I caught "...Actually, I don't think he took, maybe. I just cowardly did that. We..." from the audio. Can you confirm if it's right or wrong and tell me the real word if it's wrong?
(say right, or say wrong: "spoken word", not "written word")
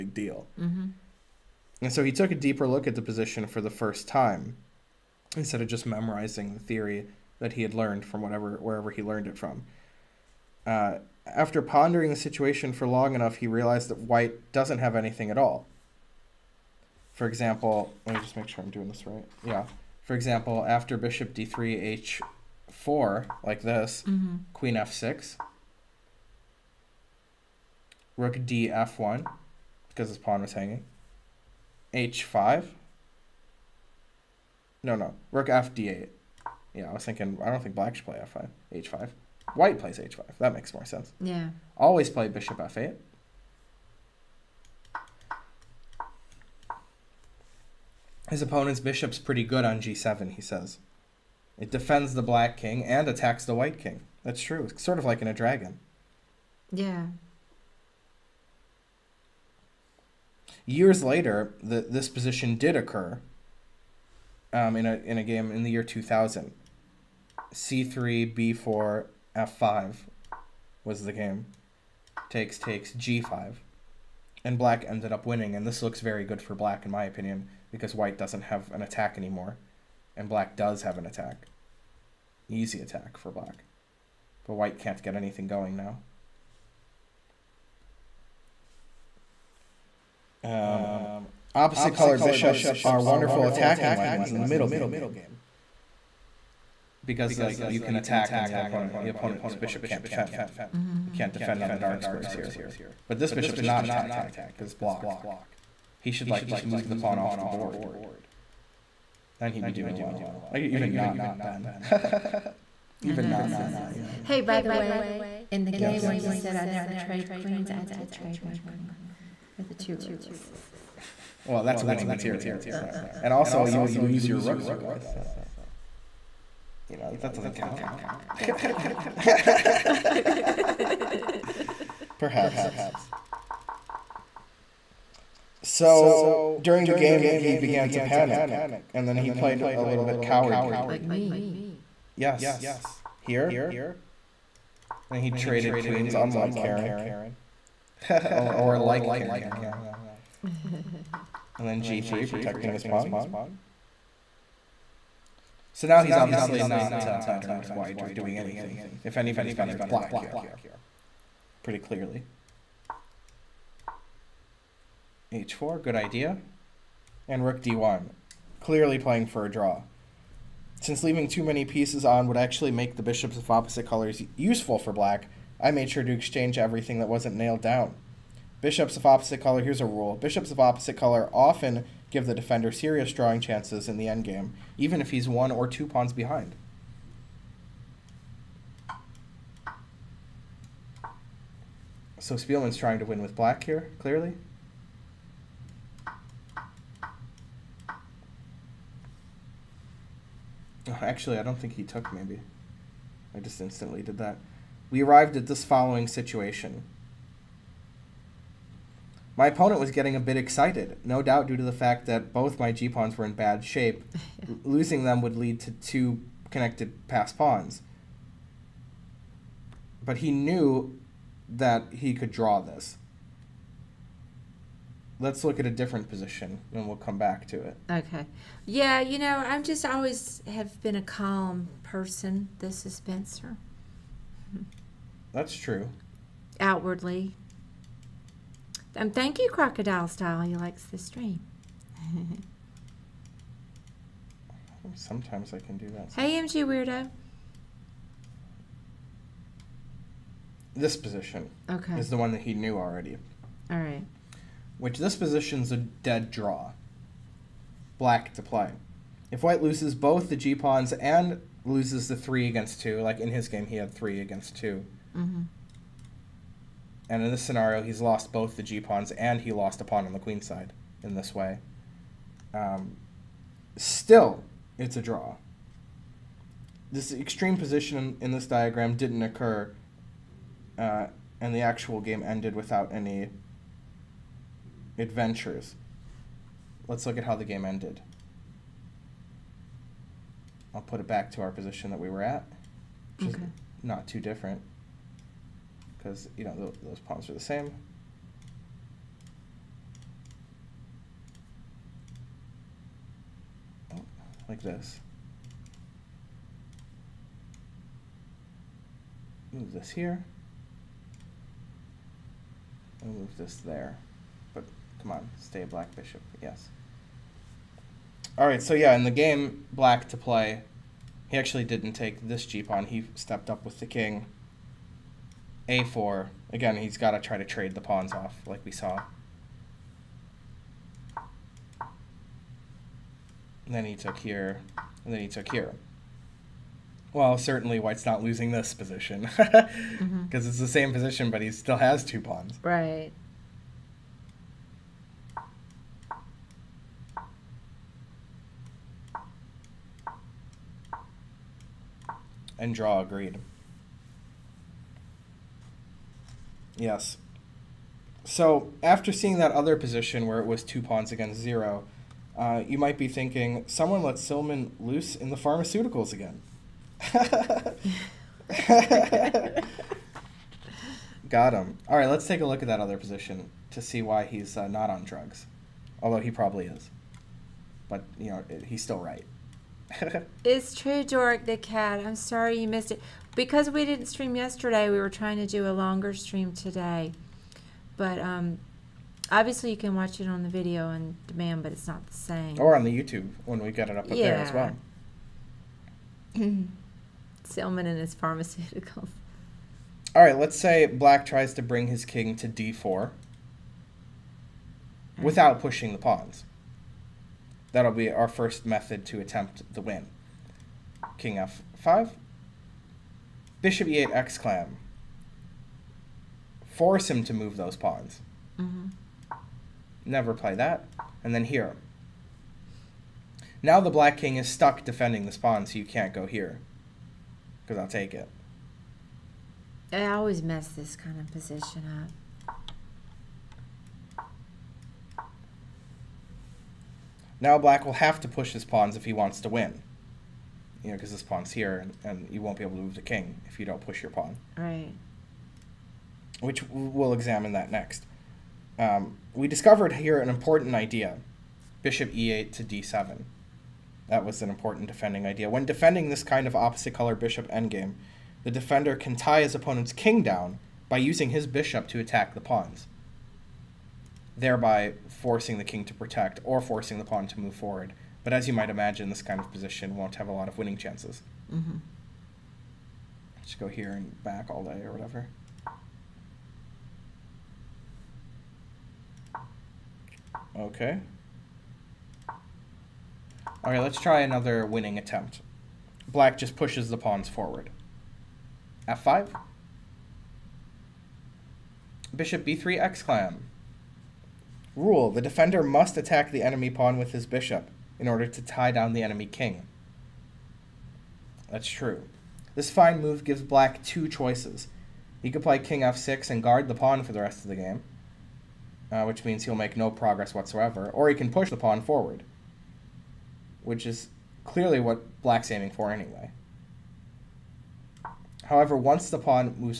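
wrong: "instantly", not "cowardly".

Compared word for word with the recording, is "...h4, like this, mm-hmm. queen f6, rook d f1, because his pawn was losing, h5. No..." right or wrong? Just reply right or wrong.
wrong.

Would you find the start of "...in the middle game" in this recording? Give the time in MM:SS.
01:34.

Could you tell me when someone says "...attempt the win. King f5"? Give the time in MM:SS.
06:49.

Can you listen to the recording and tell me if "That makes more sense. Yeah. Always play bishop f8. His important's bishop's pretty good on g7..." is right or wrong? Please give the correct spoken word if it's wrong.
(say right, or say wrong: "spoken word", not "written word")
wrong: "opponent", not "important".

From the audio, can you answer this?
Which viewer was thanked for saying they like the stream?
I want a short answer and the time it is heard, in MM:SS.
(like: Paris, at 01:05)
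Crocodile Style, at 03:59.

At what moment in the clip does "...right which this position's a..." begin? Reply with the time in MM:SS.
04:13.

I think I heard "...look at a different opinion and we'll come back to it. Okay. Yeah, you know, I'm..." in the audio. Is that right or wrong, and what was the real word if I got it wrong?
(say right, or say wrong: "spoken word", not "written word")
wrong: "position", not "opinion".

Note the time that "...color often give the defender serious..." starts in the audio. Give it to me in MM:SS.
03:00.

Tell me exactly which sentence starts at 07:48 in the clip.
But as you might imagine, this kind of position won't have a lot of winning chances.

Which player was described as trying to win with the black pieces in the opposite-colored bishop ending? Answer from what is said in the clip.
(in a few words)
Speelman.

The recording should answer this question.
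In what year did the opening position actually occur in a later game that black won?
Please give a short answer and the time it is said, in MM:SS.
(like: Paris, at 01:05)
2000, at 01:05.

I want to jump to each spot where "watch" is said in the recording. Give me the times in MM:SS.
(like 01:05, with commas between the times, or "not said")
06:29.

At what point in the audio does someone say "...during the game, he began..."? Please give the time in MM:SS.
02:16.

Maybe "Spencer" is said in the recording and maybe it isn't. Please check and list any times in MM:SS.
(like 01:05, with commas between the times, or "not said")
03:52.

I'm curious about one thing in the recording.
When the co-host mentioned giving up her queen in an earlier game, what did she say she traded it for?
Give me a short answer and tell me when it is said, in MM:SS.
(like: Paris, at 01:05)
two rooks, at 01:59.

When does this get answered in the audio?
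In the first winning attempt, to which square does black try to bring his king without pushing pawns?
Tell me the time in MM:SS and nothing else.
06:42.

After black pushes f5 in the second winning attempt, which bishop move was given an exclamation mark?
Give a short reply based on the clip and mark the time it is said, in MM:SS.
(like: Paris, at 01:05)
Bishop b3, at 08:12.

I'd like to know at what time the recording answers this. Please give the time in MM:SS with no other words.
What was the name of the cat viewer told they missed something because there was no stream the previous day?
06:21.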